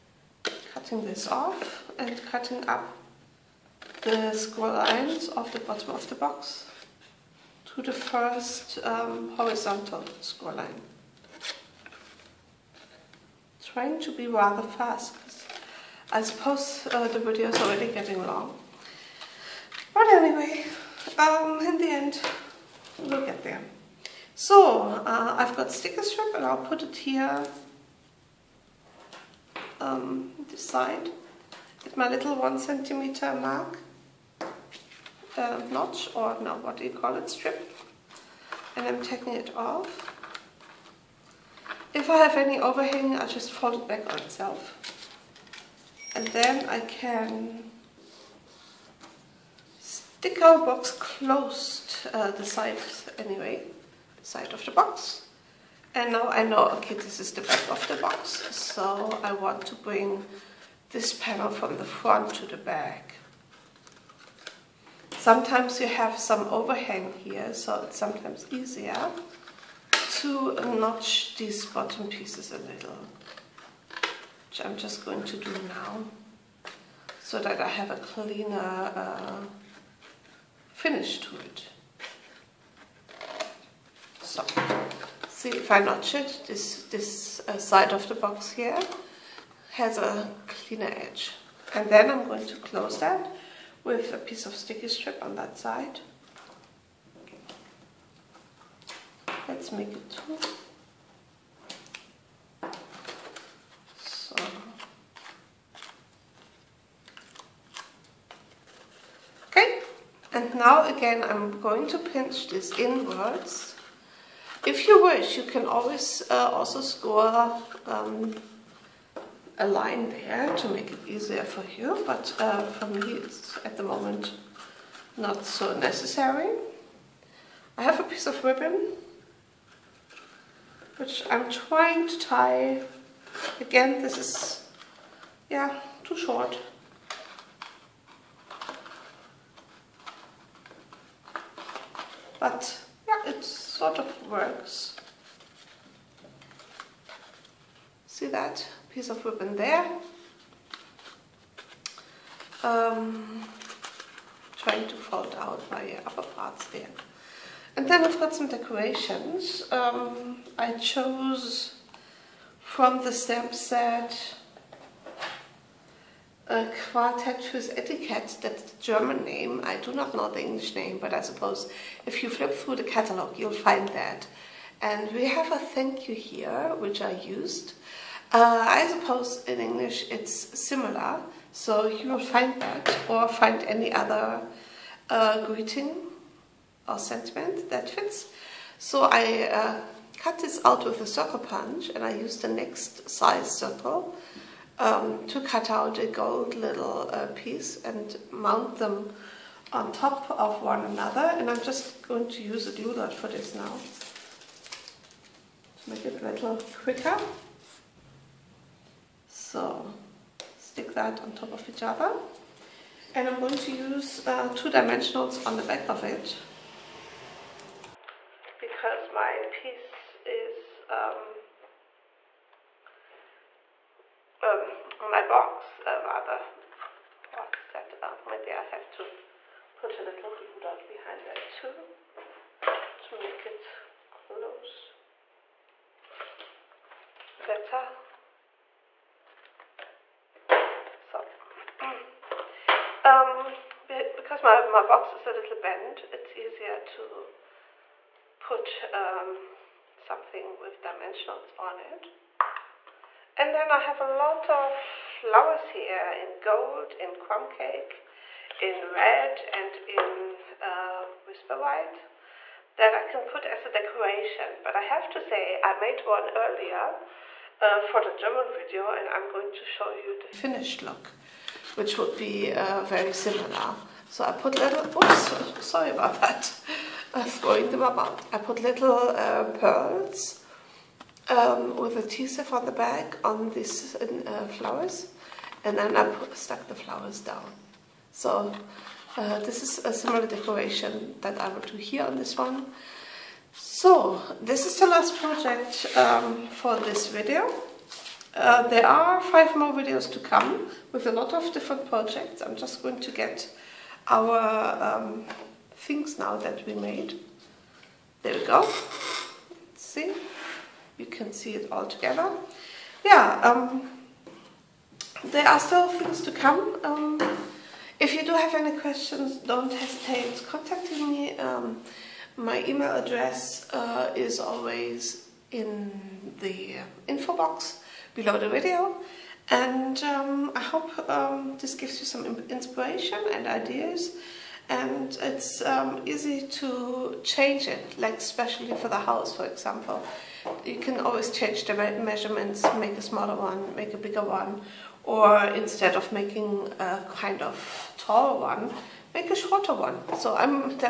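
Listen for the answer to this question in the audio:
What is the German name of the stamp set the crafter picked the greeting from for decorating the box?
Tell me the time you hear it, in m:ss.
2:46.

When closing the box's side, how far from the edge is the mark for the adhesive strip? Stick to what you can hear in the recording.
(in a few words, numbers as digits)
1 centimeter.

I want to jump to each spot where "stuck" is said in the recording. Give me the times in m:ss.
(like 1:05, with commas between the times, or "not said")
4:46.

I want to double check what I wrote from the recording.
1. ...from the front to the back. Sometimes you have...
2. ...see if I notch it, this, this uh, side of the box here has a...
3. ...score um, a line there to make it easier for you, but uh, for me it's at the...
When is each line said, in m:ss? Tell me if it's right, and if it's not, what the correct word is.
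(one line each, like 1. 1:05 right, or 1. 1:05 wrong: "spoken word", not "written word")
1. 1:01 right
2. 1:25 right
3. 1:56 right.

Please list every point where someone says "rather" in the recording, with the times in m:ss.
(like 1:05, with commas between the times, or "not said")
0:14, 3:46.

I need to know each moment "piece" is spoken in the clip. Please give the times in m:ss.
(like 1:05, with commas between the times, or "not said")
1:12, 1:34, 2:08, 2:28, 3:17, 3:39.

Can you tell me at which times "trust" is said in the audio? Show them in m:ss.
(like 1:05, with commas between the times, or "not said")
not said.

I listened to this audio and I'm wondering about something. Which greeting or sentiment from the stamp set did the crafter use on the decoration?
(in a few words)
Thank you.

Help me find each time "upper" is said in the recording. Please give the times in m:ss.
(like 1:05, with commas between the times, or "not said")
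2:36.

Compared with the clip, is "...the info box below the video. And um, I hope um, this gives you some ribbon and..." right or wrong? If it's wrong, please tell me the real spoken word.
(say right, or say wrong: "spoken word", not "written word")
wrong: "inspiration", not "ribbon".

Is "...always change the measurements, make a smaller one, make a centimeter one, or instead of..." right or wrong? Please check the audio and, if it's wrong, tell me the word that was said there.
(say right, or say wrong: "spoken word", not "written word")
wrong: "bigger", not "centimeter".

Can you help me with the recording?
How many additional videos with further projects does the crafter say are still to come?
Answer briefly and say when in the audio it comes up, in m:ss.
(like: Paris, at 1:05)
5, at 4:59.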